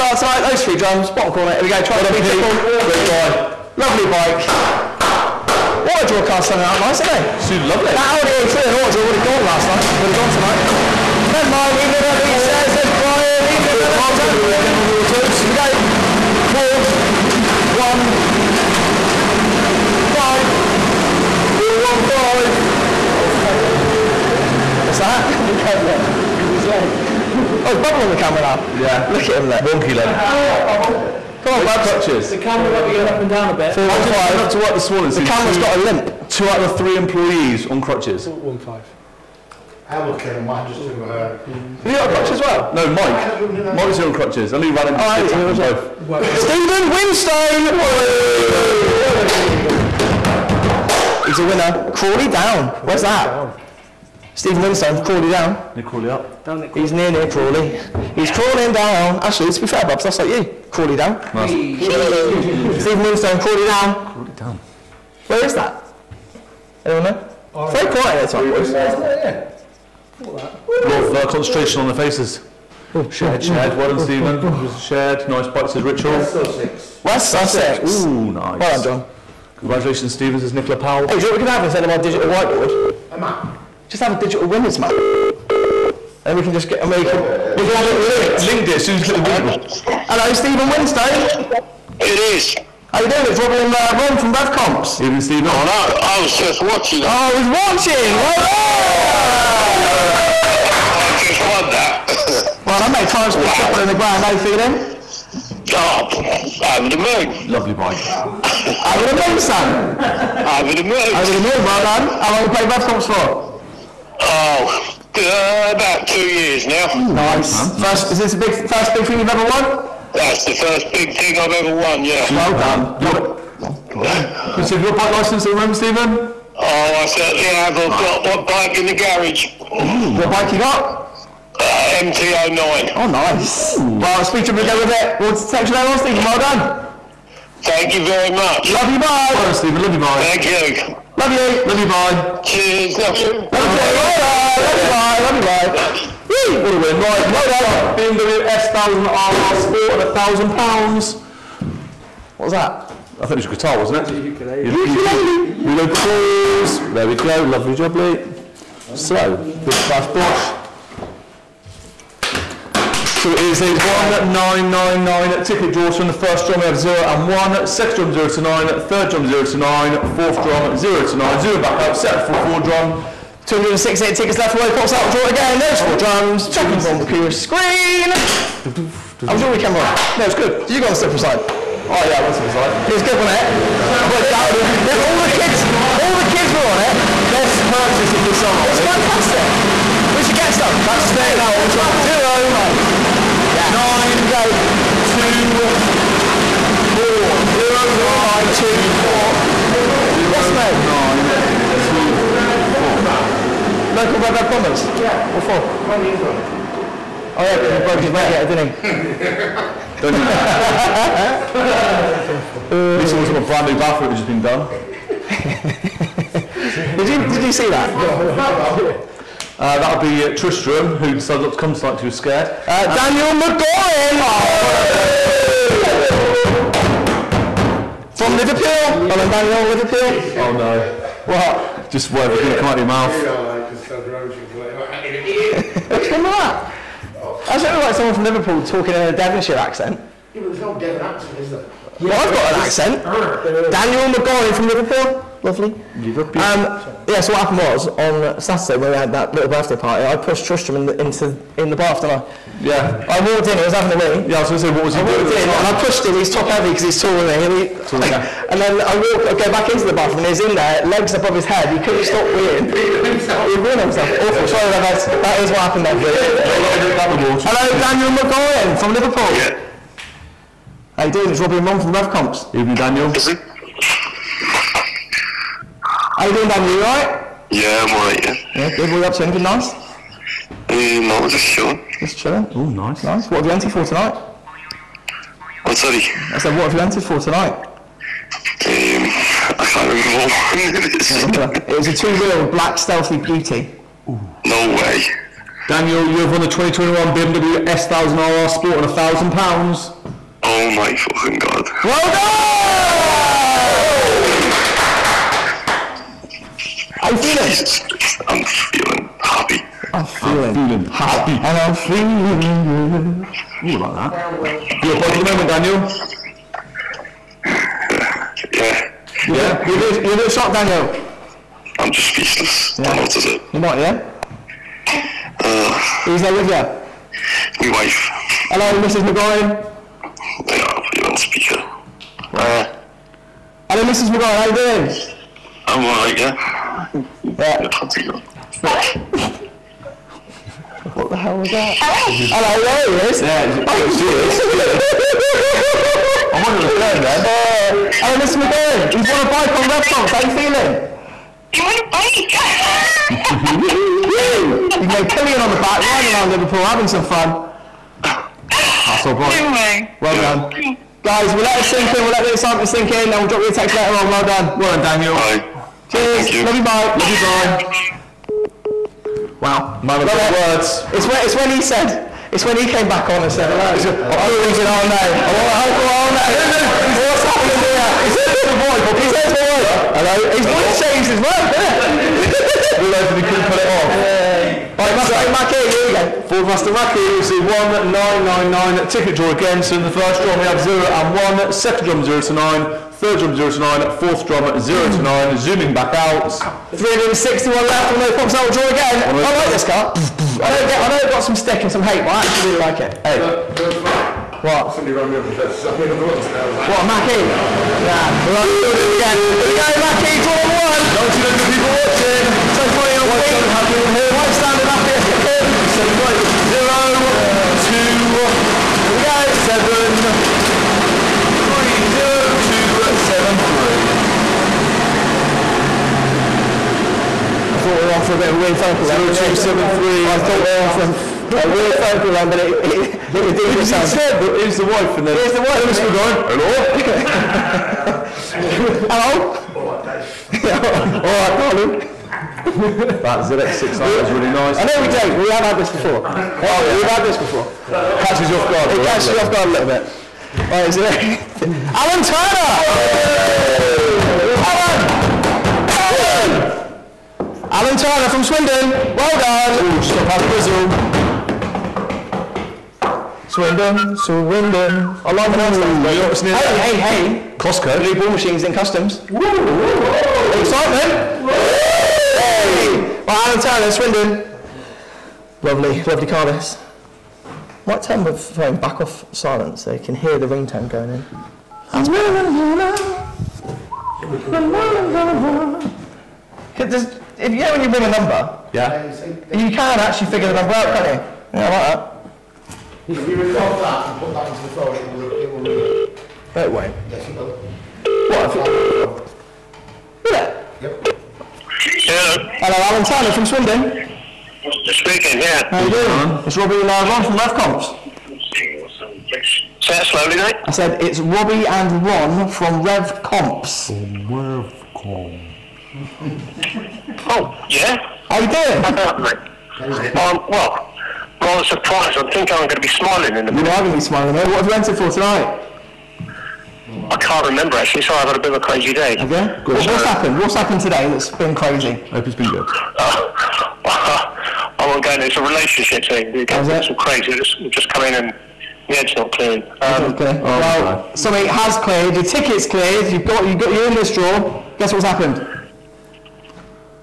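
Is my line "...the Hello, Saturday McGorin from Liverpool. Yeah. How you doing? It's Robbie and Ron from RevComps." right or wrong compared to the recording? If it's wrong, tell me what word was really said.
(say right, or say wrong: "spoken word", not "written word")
wrong: "Daniel", not "Saturday".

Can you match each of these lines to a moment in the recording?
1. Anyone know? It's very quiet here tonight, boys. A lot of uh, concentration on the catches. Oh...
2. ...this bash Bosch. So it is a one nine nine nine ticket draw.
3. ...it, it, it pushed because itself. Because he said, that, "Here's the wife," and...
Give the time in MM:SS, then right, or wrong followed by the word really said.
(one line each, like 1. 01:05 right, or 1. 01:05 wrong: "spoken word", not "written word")
1. 01:06 wrong: "faces", not "catches"
2. 02:39 right
3. 07:12 wrong: "redeemed", not "pushed".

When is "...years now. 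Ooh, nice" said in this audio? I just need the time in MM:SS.
01:56.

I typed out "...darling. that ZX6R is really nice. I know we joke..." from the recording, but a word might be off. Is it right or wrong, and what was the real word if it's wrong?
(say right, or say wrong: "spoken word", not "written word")
right.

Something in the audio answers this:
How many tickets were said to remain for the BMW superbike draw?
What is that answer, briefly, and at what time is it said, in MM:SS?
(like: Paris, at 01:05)
268, at 02:53.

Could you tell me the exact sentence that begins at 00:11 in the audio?
Never mind, evening Revy, shares, says Brian, evening Revy.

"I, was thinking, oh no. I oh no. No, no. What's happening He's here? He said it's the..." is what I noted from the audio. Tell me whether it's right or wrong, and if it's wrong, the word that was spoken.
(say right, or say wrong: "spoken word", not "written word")
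right.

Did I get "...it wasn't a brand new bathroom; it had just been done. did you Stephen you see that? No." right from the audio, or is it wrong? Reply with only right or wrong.
wrong.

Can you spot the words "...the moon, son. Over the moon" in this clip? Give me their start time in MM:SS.
01:49.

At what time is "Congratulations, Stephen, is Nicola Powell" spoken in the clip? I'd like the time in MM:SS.
01:19.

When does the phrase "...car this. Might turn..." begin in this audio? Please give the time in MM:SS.
07:56.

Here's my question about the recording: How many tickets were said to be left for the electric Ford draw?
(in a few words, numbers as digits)
361.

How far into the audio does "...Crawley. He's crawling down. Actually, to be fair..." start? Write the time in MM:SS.
00:57.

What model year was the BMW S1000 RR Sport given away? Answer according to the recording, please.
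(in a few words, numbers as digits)
2021.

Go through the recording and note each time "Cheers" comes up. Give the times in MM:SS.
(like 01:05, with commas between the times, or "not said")
02:22, 06:05.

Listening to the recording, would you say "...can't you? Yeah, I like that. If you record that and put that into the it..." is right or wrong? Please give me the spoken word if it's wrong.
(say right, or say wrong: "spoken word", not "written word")
right.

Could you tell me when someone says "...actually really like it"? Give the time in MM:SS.
06:42.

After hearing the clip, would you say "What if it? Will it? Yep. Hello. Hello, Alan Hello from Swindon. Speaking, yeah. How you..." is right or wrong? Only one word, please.
wrong.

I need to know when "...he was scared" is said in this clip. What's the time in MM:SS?
03:42.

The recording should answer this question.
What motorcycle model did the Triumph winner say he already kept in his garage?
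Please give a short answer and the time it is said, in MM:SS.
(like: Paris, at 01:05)
MT09, at 02:11.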